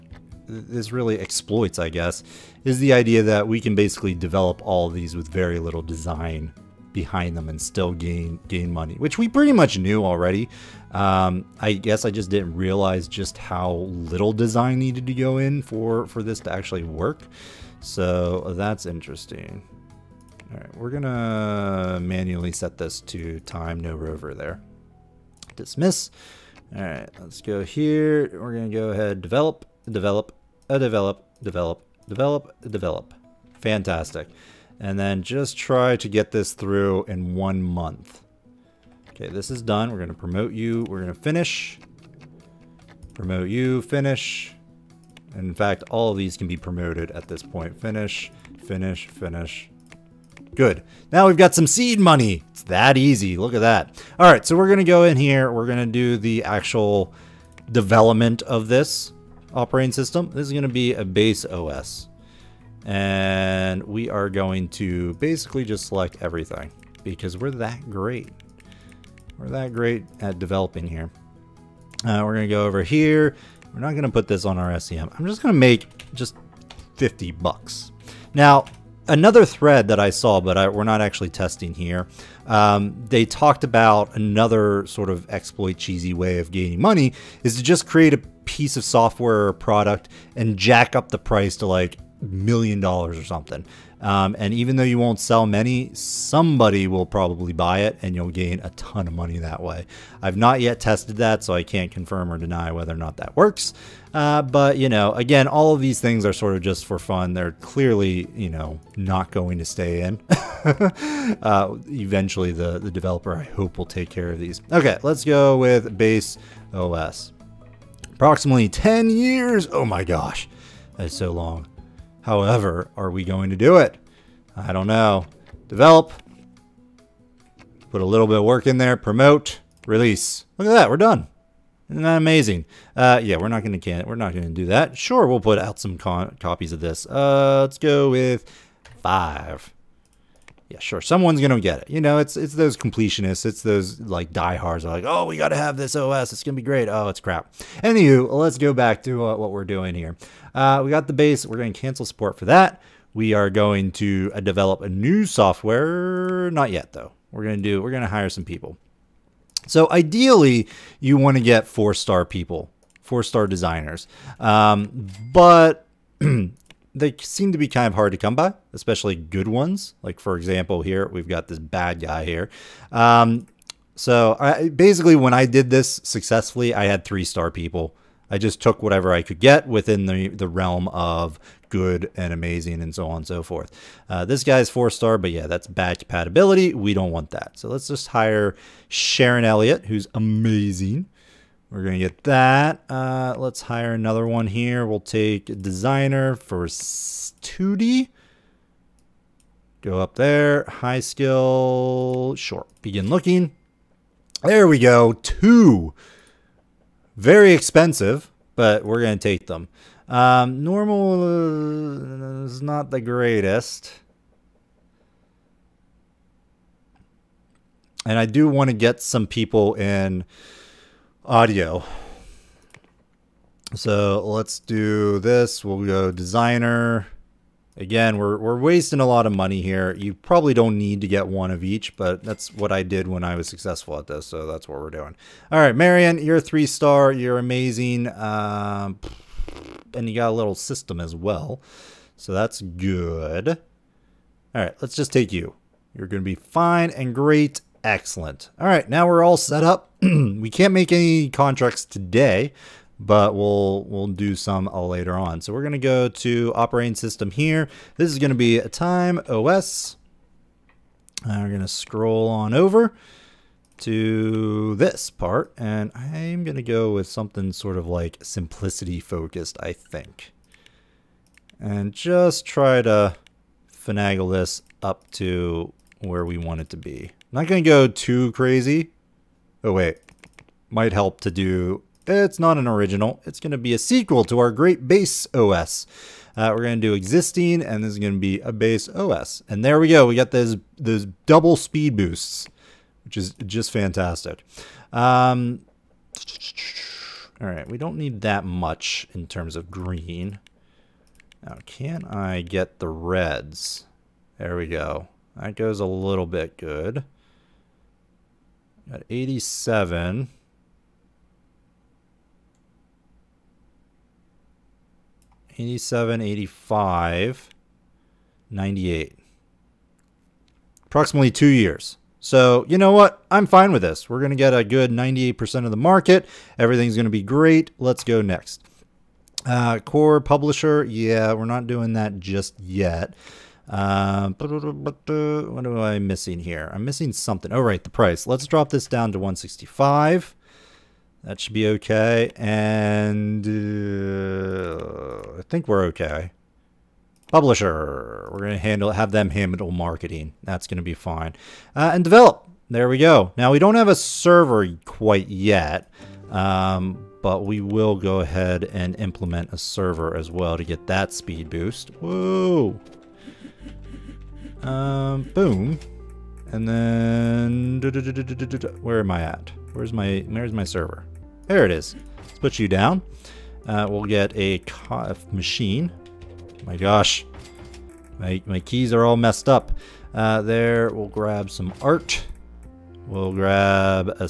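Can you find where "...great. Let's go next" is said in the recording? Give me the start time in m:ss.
5:27.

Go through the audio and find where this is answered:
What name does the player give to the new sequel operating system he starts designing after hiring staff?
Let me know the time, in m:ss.
4:18.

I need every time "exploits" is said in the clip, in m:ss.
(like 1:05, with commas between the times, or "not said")
0:01, 1:25.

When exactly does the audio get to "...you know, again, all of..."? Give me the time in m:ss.
1:44.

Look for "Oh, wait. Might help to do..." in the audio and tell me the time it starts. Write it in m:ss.
4:39.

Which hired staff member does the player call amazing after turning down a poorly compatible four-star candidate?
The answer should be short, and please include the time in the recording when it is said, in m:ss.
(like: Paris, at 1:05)
Sharon Elliott, at 3:08.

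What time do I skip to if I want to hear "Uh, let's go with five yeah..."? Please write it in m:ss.
2:17.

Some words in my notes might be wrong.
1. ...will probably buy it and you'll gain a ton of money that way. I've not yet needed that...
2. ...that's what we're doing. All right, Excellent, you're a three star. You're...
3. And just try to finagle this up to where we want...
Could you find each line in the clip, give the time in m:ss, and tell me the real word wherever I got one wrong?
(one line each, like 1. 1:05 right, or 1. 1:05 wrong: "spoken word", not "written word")
1. 1:36 wrong: "tested", not "needed"
2. 3:54 wrong: "Marion", not "Excellent"
3. 4:31 right.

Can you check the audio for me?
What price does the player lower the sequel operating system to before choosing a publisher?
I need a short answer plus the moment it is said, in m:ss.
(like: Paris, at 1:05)
165, at 5:39.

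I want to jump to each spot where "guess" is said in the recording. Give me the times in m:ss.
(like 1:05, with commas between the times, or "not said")
0:01, 0:11.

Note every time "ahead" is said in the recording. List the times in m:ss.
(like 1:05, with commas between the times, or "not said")
0:28, 5:58.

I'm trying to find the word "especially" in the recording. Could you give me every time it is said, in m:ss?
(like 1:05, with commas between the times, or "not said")
2:48.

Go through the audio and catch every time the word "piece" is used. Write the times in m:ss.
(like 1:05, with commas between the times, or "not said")
1:28.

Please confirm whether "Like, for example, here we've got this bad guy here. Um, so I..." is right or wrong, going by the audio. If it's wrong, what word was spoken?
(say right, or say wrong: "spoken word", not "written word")
right.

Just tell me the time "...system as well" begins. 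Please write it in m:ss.
4:00.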